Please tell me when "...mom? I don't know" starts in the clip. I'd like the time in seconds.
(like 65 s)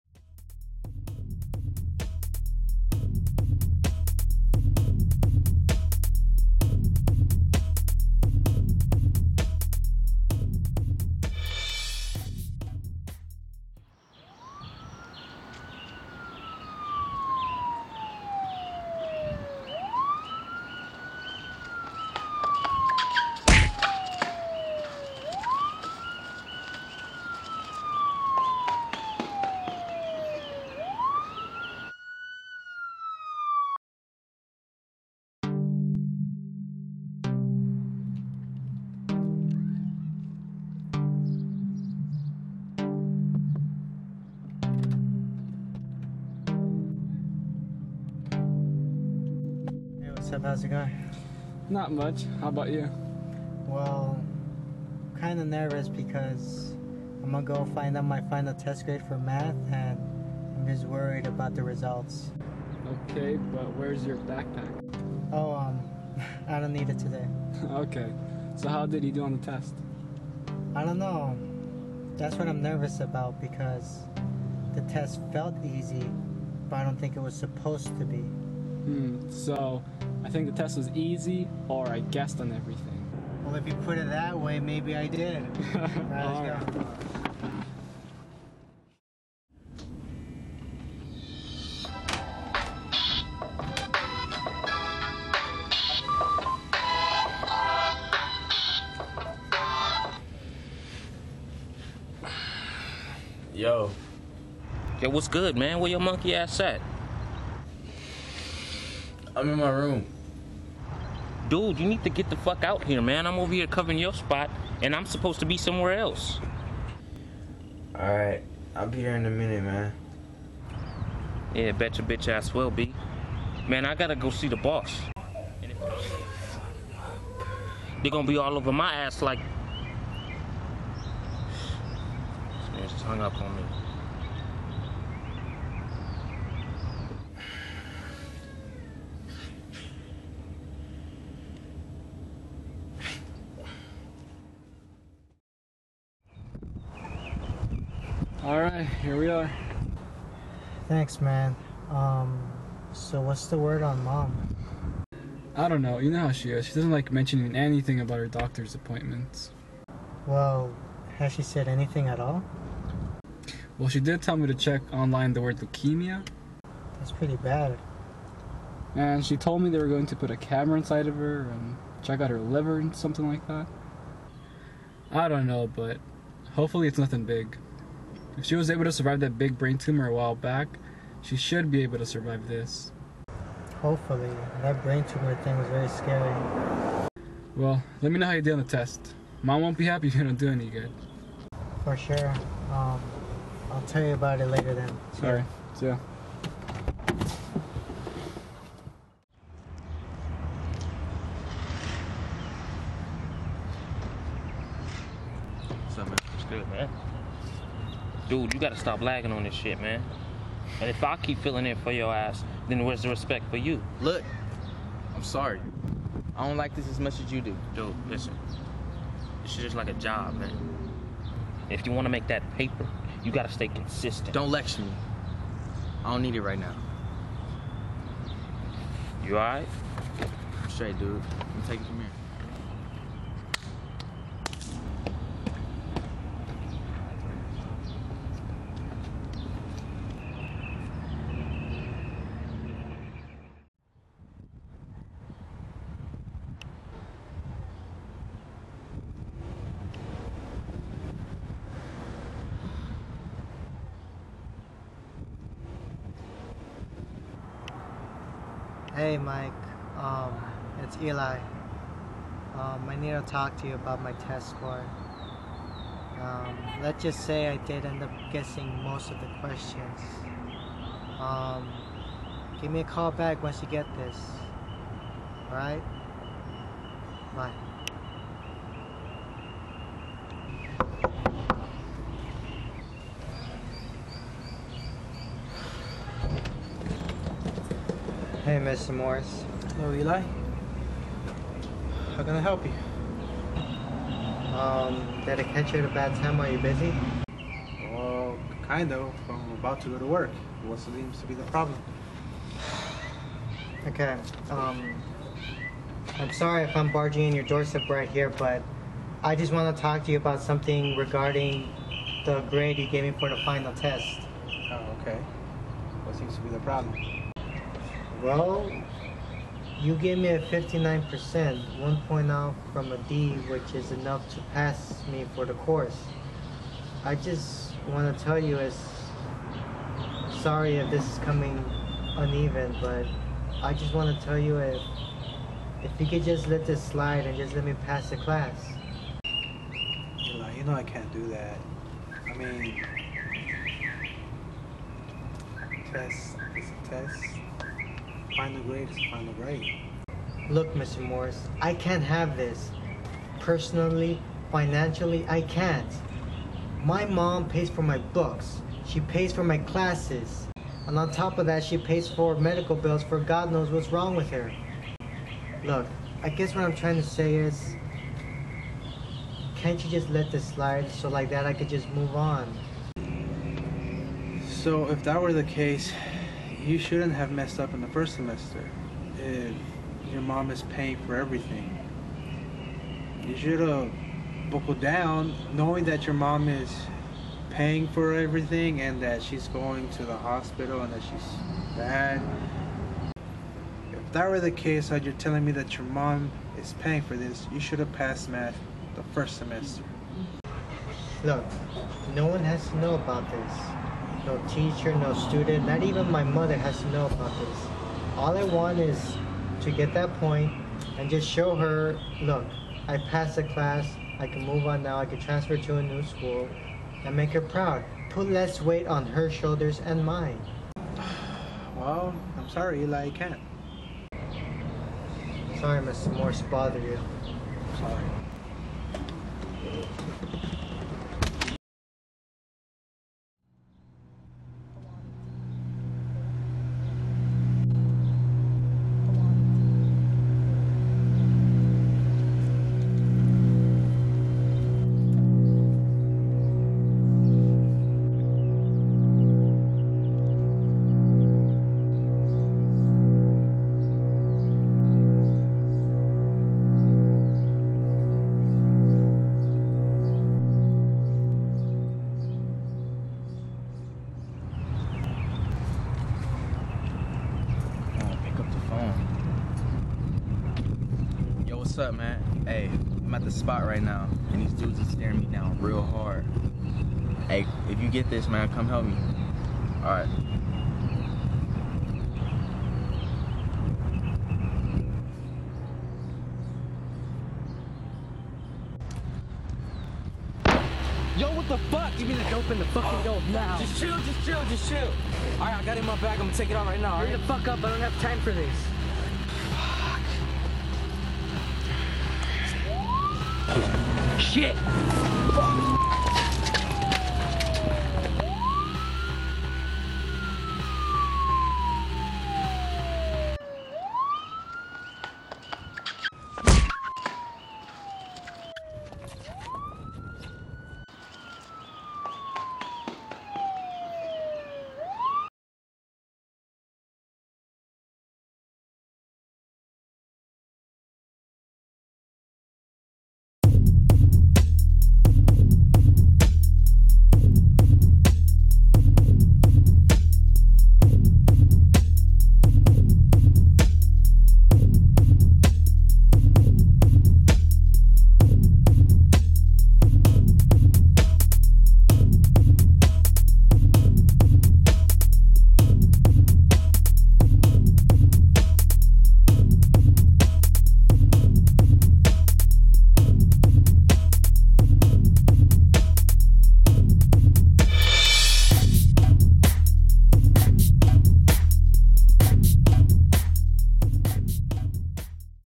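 154 s.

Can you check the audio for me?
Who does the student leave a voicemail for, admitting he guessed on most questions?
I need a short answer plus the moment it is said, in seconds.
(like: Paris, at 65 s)
Mike, at 259 s.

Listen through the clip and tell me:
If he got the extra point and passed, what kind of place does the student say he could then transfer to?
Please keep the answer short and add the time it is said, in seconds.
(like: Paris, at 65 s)
a new school, at 415 s.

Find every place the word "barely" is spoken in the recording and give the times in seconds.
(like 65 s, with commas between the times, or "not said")
not said.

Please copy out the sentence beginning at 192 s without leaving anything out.
Um, I'll tell you about it later then.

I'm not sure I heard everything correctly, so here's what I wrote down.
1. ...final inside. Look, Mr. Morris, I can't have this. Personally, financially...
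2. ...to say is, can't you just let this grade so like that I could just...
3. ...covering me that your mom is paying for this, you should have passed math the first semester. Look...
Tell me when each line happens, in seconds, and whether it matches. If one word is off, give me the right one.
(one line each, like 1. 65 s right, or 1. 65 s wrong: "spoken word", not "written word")
1. 349 s wrong: "grade", not "inside"
2. 366 s wrong: "slide", not "grade"
3. 395 s wrong: "telling", not "covering".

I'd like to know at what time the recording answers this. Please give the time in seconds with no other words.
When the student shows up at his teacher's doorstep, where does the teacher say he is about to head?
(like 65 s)
300 s.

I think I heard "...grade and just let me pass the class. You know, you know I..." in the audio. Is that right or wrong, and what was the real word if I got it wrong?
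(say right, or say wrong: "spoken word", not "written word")
wrong: "slide", not "grade".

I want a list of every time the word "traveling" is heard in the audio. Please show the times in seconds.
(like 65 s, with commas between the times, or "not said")
not said.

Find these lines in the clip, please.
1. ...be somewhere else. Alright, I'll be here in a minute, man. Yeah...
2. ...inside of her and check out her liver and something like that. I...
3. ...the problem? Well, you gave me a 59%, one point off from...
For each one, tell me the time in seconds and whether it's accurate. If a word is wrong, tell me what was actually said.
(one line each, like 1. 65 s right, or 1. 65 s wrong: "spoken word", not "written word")
1. 115 s right
2. 170 s right
3. 316 s right.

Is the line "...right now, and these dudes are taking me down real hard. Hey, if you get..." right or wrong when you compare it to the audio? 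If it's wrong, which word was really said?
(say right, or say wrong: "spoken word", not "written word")
wrong: "staring", not "taking".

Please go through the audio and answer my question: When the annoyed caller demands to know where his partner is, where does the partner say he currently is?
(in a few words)
in my room.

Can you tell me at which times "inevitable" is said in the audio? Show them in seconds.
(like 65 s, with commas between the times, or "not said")
not said.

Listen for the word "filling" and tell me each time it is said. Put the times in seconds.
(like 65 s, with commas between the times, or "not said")
211 s.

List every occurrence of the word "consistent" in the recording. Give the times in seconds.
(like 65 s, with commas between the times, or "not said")
223 s.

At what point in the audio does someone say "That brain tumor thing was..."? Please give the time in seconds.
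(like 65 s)
184 s.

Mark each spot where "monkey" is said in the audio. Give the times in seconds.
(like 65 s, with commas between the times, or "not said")
105 s.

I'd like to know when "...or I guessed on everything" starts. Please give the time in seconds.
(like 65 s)
81 s.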